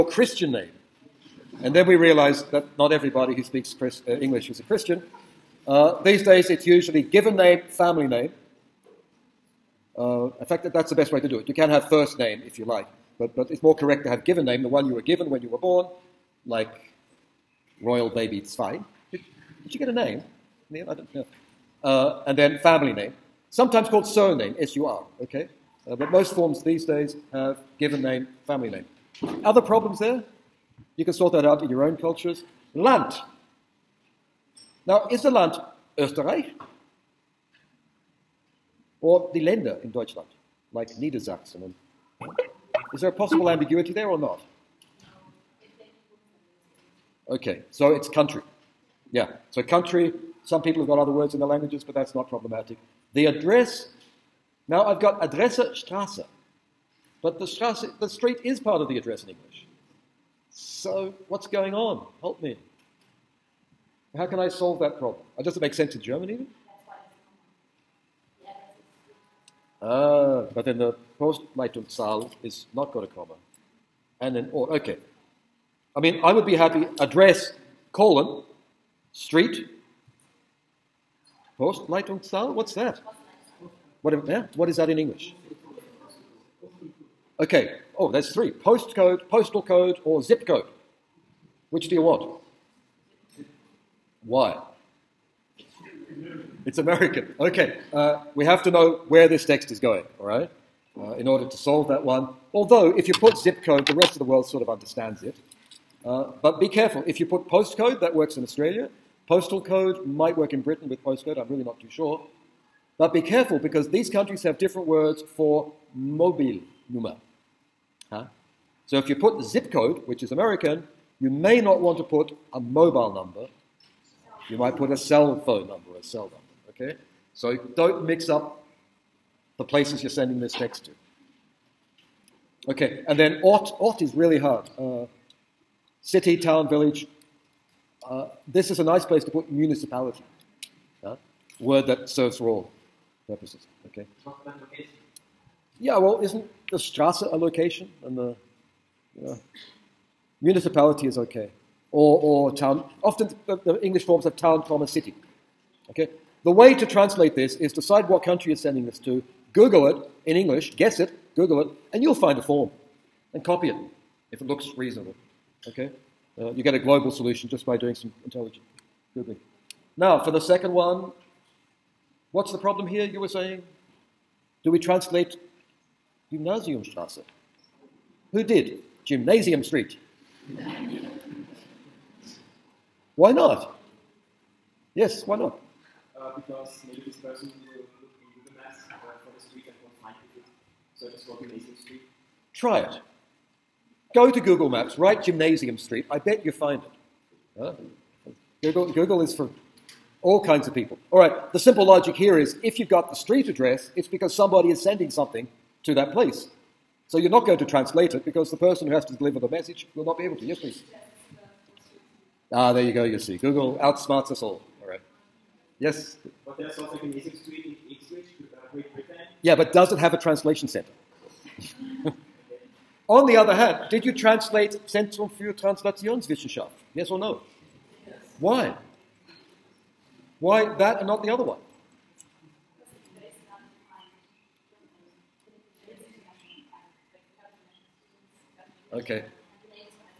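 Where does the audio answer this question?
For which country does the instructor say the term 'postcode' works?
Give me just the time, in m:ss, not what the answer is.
1:48.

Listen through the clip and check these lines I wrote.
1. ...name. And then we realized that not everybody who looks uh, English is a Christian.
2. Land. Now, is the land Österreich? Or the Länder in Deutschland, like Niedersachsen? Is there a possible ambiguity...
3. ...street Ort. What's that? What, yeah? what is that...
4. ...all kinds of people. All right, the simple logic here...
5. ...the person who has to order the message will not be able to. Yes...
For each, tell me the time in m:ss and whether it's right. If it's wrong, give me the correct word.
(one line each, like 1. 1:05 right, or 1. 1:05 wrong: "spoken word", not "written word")
1. 0:00 wrong: "speaks", not "looks"
2. 0:32 right
3. 1:19 wrong: "Postleitzahl", not "Ort"
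4. 3:20 right
5. 3:28 wrong: "deliver", not "order".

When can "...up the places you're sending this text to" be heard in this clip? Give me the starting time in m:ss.
2:08.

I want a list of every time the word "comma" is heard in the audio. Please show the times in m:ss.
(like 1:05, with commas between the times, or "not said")
1:13, 2:34.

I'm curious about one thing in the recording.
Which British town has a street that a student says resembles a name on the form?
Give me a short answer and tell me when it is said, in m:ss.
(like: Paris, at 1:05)
Ipswich, at 3:37.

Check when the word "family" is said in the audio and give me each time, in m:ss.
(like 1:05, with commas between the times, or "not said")
0:07, 0:22, 0:28.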